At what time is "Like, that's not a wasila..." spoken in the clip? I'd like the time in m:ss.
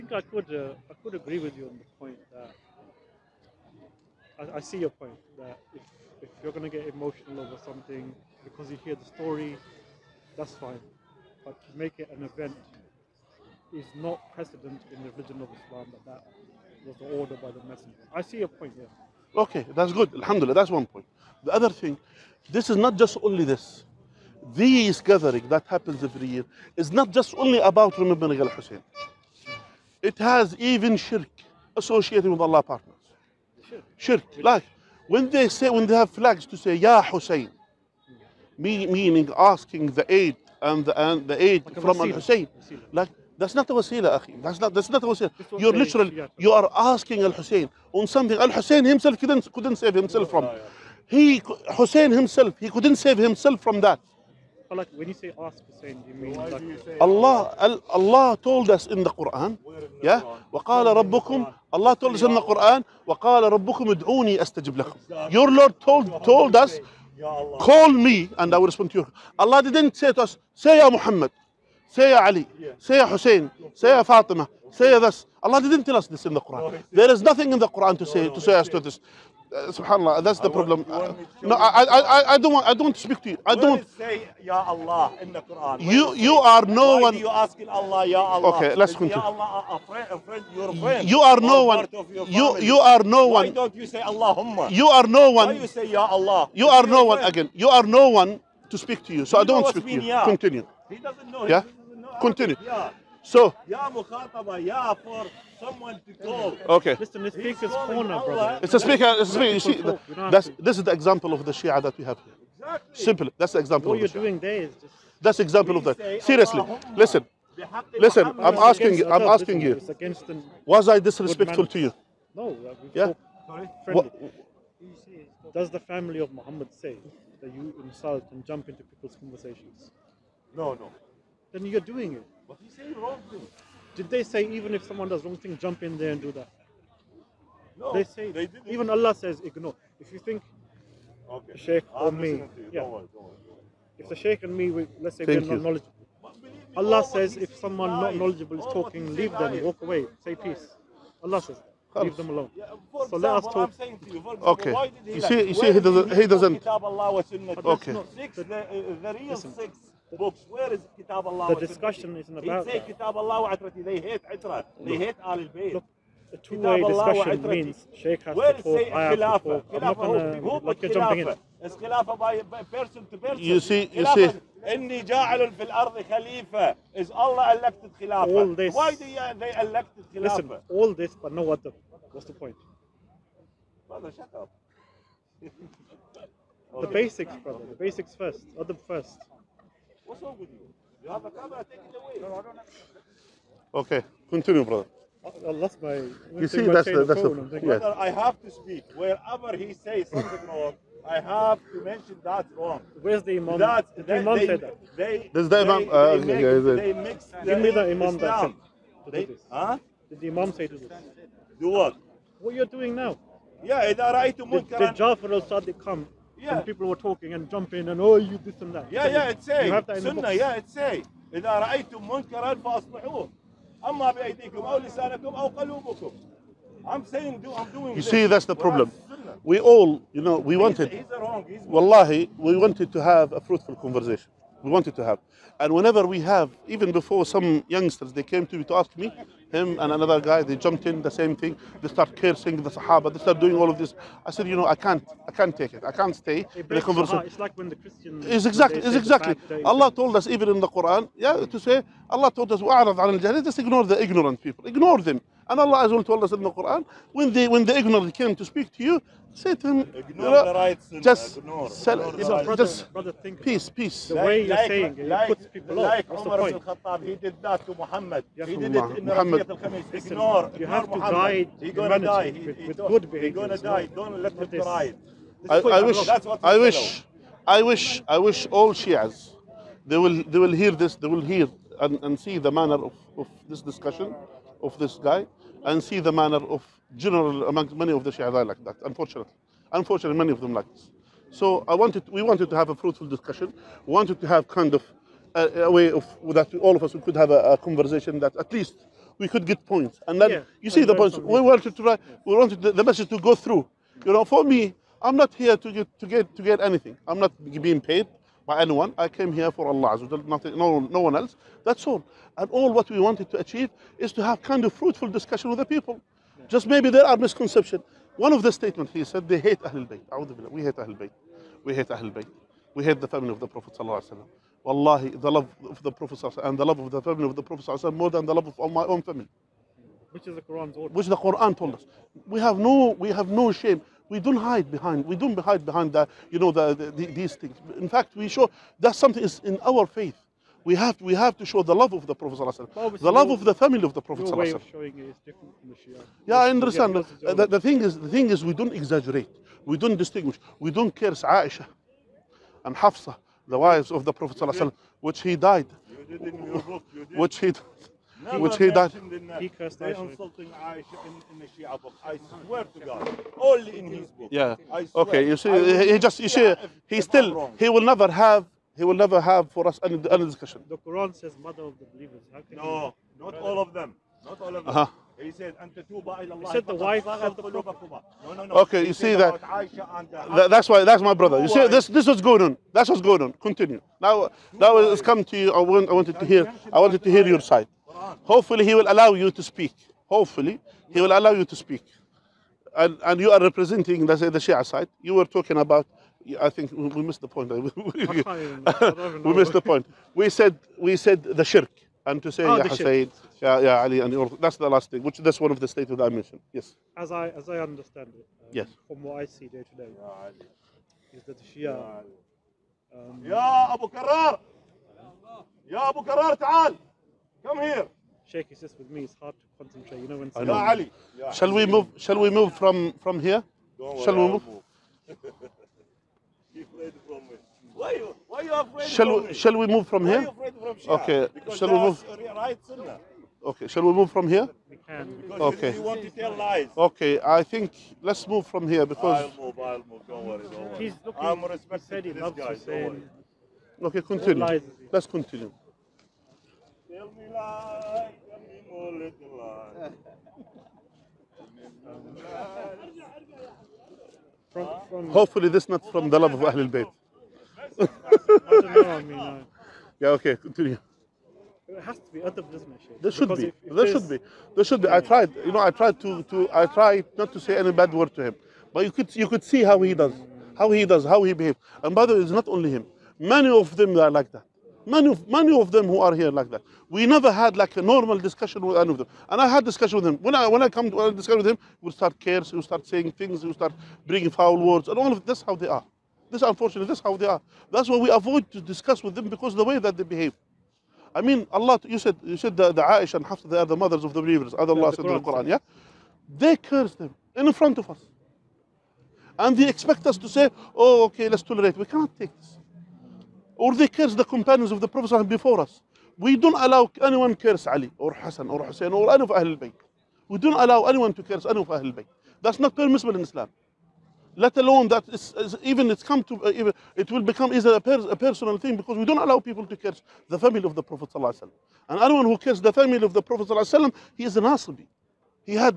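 0:42.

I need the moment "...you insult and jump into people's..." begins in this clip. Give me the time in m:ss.
2:07.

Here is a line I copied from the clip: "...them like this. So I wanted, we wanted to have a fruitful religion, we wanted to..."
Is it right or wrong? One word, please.
wrong.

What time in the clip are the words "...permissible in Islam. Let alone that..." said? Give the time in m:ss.
8:32.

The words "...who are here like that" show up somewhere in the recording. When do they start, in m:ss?
7:55.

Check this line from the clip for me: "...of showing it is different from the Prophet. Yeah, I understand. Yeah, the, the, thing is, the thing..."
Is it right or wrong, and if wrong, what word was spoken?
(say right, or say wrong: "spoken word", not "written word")
wrong: "Shia", not "Prophet".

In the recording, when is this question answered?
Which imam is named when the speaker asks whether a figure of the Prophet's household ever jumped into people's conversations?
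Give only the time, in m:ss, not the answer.
3:34.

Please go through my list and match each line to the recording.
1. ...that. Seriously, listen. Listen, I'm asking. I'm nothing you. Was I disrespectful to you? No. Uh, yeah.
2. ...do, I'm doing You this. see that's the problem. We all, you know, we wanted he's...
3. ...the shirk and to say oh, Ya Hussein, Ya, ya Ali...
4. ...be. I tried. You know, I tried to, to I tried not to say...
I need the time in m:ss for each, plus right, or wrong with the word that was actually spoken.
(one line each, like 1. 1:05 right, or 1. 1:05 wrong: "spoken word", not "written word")
1. 1:55 wrong: "asking", not "nothing"
2. 3:47 right
3. 6:41 right
4. 7:44 right.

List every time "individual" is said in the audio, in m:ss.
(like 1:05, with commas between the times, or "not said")
not said.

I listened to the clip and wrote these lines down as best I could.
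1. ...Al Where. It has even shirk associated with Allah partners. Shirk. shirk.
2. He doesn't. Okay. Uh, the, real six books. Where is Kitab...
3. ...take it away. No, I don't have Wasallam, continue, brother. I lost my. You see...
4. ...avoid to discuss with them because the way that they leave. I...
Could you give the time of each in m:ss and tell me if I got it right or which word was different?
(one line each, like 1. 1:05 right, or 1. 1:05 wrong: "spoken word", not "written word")
1. 0:28 wrong: "Hussein", not "Where"
2. 2:36 right
3. 3:11 wrong: "Okay", not "Wasallam"
4. 8:08 wrong: "behave", not "leave".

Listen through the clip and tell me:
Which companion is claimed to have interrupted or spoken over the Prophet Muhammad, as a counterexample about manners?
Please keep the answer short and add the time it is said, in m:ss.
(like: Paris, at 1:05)
Umar al Khattab, at 4:26.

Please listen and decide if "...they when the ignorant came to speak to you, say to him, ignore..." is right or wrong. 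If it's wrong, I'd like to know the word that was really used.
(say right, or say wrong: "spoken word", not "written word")
right.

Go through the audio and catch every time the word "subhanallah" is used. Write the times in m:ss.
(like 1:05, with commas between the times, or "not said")
1:19.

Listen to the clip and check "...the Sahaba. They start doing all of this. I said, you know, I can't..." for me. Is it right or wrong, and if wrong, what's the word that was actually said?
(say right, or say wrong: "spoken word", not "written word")
right.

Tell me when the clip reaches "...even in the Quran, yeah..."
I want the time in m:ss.
4:10.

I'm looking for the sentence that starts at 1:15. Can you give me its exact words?
Allah didn't tell us this in the Quran.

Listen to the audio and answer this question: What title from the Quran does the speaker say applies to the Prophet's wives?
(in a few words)
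Mother of the believers.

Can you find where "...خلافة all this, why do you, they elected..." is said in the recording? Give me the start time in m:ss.
2:57.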